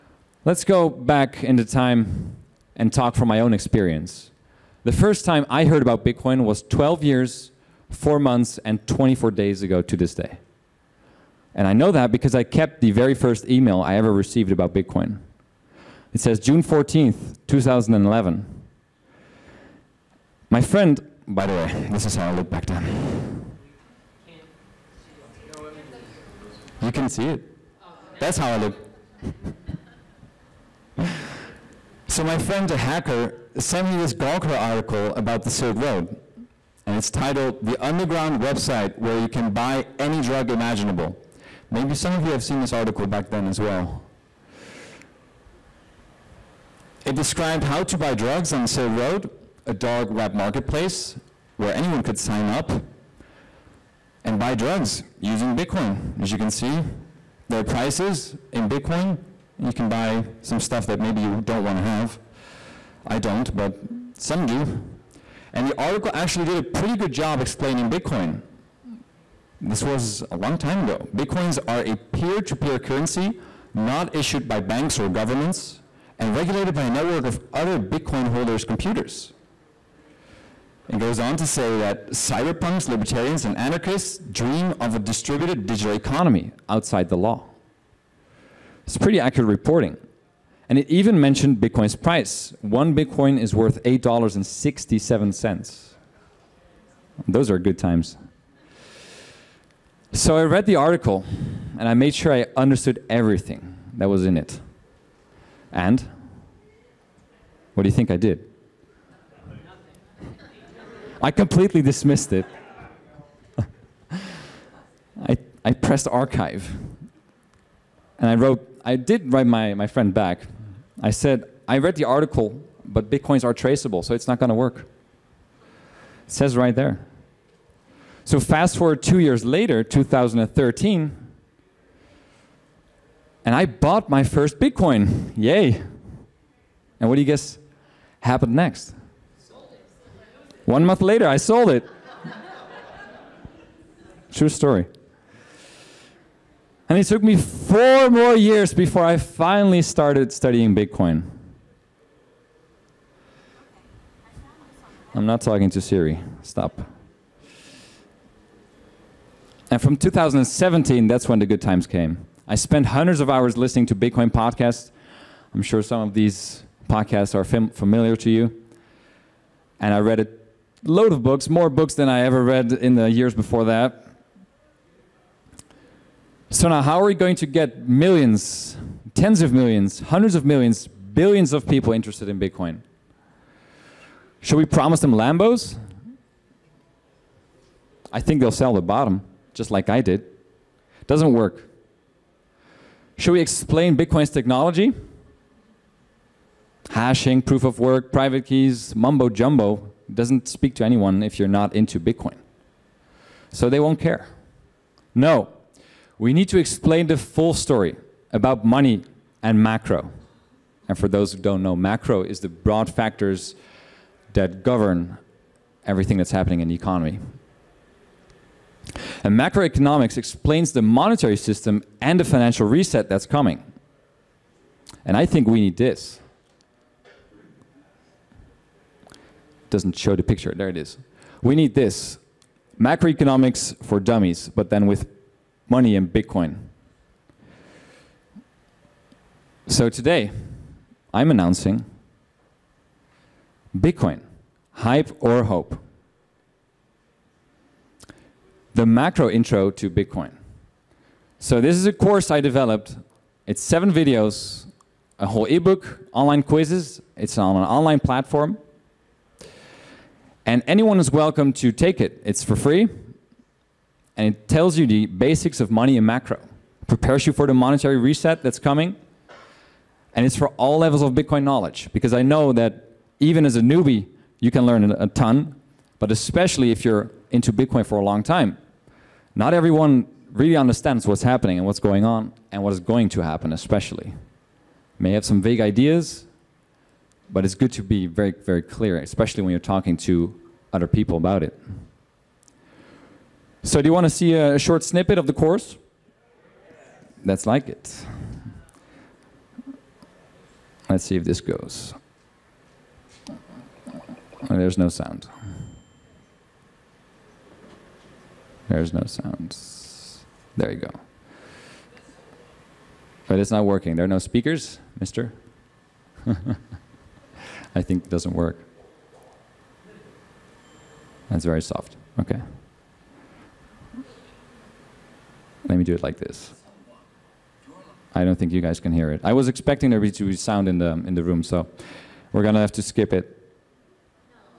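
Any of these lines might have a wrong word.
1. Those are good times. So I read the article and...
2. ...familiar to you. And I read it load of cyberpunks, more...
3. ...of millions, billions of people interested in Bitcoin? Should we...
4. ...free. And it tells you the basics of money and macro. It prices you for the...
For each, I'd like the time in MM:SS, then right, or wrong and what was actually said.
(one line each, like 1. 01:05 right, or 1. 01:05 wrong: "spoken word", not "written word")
1. 01:37 right
2. 02:47 wrong: "books", not "cyberpunks"
3. 03:00 right
4. 04:22 wrong: "prepares", not "prices".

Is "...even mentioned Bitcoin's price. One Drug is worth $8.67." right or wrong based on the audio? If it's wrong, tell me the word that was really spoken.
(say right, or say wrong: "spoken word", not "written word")
wrong: "Bitcoin", not "Drug".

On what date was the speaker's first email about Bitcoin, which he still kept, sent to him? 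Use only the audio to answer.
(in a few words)
June 14th, 2011.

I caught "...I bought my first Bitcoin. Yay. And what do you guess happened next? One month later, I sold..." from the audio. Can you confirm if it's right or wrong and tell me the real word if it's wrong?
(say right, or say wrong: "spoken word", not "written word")
right.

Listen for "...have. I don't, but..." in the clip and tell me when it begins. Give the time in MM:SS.
01:01.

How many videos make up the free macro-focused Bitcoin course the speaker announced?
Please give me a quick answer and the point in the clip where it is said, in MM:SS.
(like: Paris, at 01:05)
7, at 04:13.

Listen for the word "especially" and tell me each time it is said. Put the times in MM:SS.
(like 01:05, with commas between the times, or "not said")
04:36, 04:43, 04:48.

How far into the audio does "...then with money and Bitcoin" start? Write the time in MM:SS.
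03:54.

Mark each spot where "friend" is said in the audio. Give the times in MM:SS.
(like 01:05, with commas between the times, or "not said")
00:20, 00:32, 01:59.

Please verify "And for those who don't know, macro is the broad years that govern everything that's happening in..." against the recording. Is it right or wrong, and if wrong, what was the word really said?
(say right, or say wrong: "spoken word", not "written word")
wrong: "factors", not "years".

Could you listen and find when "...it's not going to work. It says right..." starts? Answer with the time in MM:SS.
02:04.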